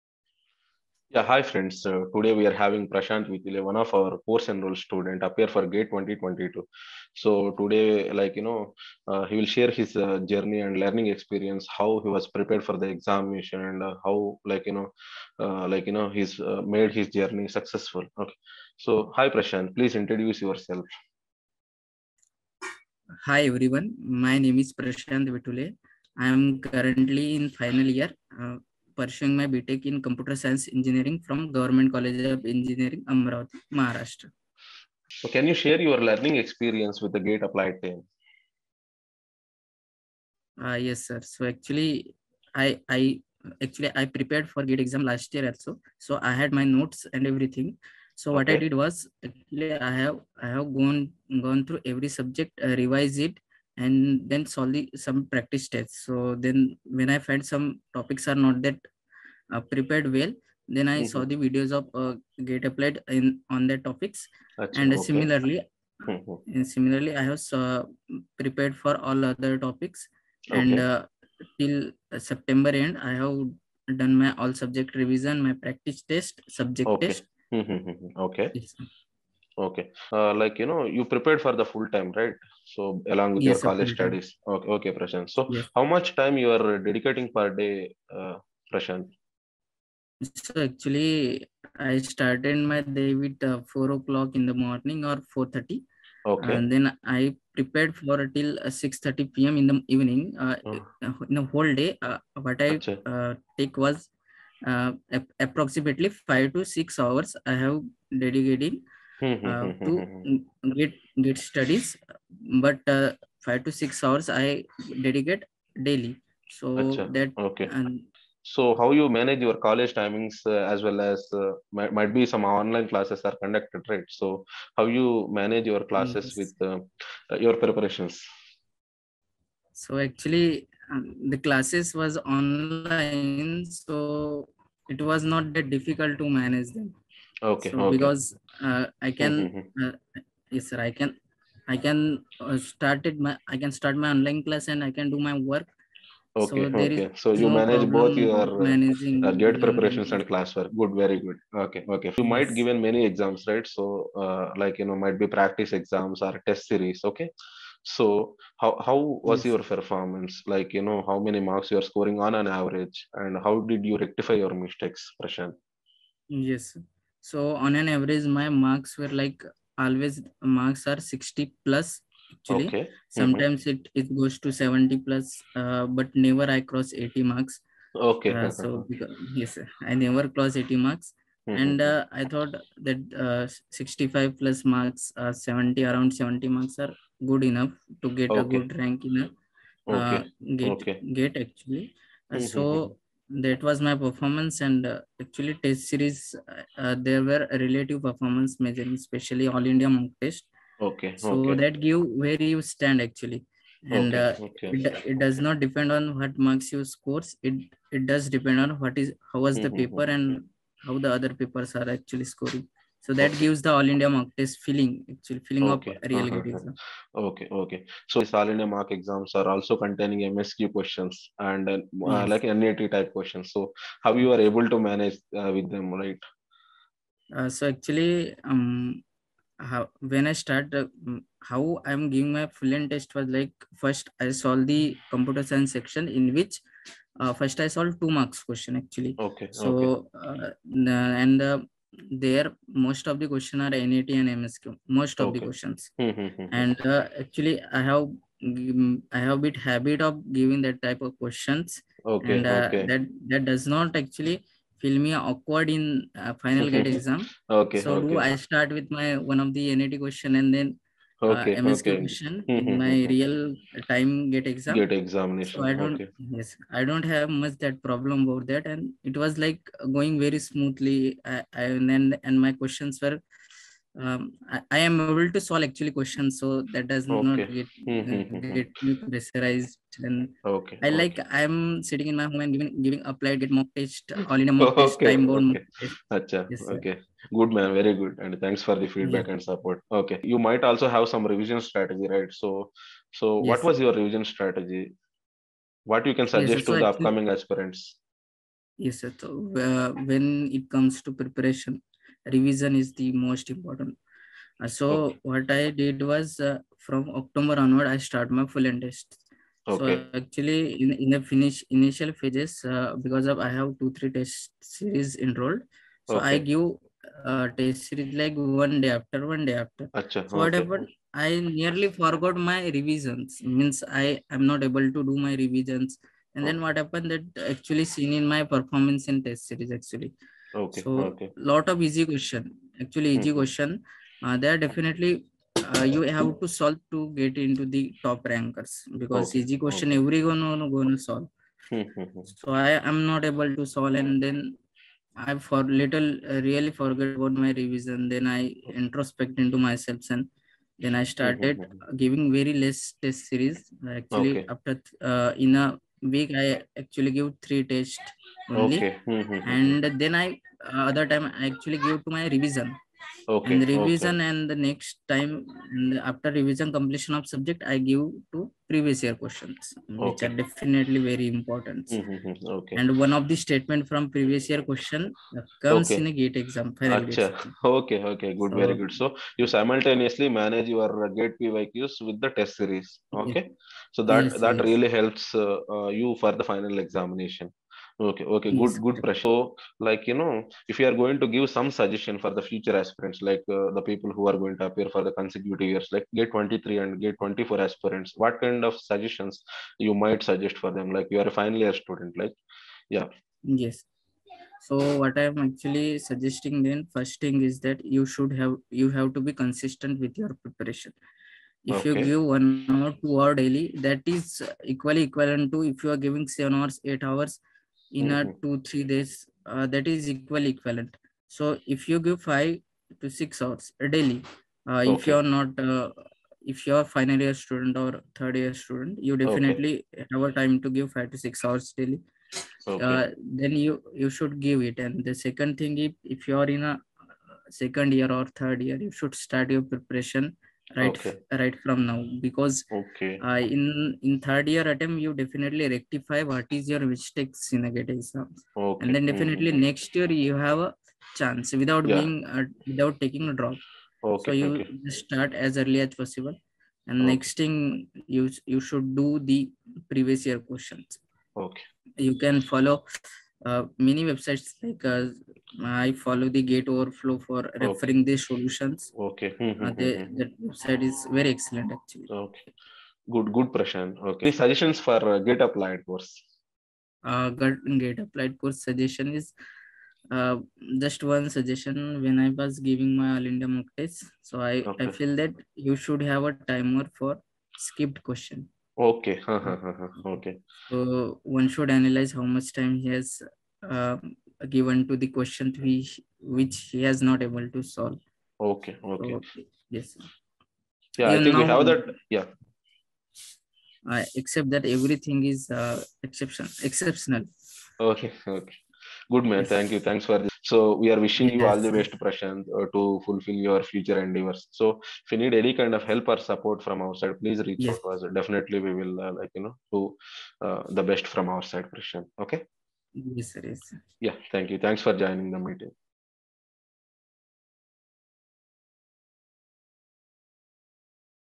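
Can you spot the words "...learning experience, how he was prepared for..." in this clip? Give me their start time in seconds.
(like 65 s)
10 s.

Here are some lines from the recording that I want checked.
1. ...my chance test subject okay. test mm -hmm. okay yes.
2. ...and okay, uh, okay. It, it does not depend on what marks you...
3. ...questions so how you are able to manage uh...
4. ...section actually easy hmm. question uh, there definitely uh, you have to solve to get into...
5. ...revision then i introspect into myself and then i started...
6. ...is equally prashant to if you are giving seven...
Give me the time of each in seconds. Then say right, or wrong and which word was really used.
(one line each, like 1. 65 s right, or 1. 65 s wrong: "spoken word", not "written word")
1. 75 s wrong: "practice", not "chance"
2. 203 s right
3. 223 s right
4. 332 s wrong: "question", not "section"
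5. 347 s right
6. 414 s wrong: "equivalent", not "prashant".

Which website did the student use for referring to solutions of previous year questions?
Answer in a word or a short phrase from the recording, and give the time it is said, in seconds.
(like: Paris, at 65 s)
Gate Overflow, at 466 s.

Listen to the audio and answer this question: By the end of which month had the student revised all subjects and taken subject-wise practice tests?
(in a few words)
September.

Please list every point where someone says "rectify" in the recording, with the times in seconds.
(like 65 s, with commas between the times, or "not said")
163 s, 445 s.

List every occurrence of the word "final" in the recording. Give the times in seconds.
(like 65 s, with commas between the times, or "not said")
27 s, 256 s, 386 s, 401 s, 426 s.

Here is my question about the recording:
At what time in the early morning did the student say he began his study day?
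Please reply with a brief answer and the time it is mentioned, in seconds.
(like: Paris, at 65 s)
4 o'clock, at 93 s.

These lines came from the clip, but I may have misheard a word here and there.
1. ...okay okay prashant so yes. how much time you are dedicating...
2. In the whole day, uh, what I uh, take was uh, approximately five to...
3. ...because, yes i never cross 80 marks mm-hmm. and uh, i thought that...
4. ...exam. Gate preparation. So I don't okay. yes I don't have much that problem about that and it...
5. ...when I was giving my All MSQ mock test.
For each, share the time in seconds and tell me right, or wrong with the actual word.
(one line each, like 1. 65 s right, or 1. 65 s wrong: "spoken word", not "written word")
1. 84 s right
2. 101 s right
3. 178 s right
4. 264 s wrong: "examination", not "preparation"
5. 482 s wrong: "India", not "MSQ".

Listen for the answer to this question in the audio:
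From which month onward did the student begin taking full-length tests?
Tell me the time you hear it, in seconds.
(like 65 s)
307 s.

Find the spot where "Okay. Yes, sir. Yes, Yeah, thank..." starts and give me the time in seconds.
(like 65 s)
522 s.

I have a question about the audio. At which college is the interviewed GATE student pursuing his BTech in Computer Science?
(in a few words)
Government College of Engineering, Amravati.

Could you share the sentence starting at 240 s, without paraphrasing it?
Uh, and uh, there most of the question are nat and msq most of okay.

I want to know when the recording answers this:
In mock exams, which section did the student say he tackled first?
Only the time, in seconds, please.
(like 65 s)
235 s.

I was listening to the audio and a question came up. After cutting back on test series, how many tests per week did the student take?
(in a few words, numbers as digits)
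3.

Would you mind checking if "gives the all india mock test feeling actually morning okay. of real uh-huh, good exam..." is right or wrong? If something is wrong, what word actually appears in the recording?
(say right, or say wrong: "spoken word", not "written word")
wrong: "feeling", not "morning".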